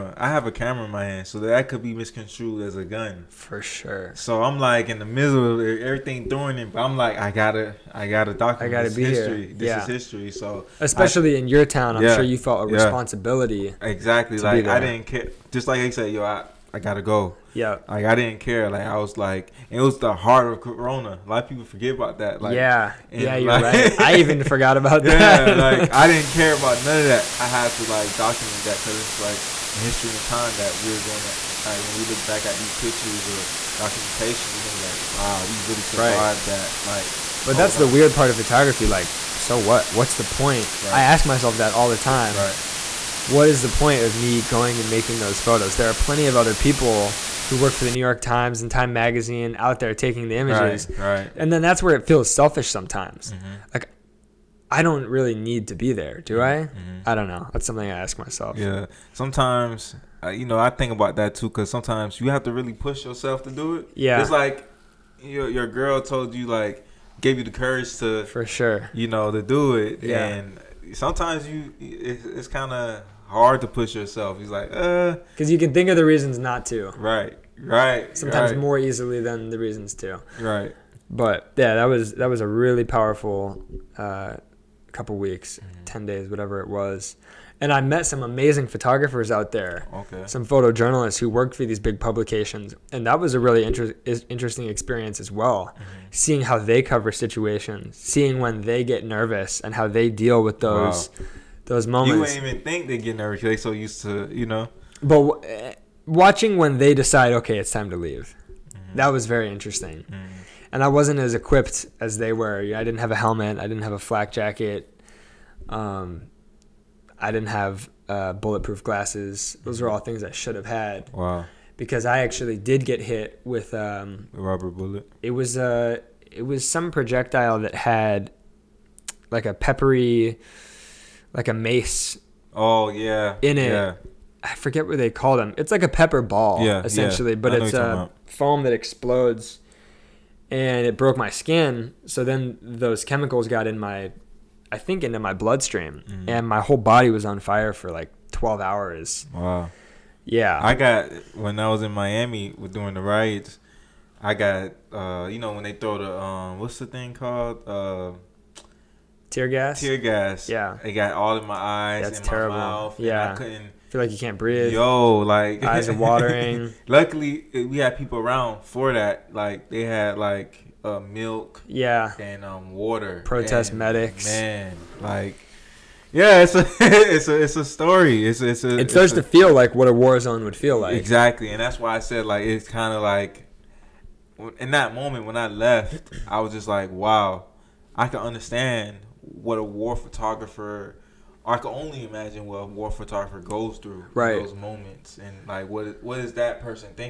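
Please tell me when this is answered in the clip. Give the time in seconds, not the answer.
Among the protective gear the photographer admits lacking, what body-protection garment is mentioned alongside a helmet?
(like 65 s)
113 s.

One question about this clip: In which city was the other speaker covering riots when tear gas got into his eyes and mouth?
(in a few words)
Miami.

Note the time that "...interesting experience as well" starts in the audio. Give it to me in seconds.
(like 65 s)
94 s.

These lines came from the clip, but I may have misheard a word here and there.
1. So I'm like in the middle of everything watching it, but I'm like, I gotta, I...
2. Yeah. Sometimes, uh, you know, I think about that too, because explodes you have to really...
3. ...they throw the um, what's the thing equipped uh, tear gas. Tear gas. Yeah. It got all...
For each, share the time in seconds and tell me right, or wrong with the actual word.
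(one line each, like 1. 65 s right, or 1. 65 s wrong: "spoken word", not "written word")
1. 4 s wrong: "throwing", not "watching"
2. 58 s wrong: "sometimes", not "explodes"
3. 155 s wrong: "called", not "equipped".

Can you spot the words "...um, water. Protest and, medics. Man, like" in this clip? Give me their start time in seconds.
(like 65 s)
172 s.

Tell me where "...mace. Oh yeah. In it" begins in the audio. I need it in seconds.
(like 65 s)
131 s.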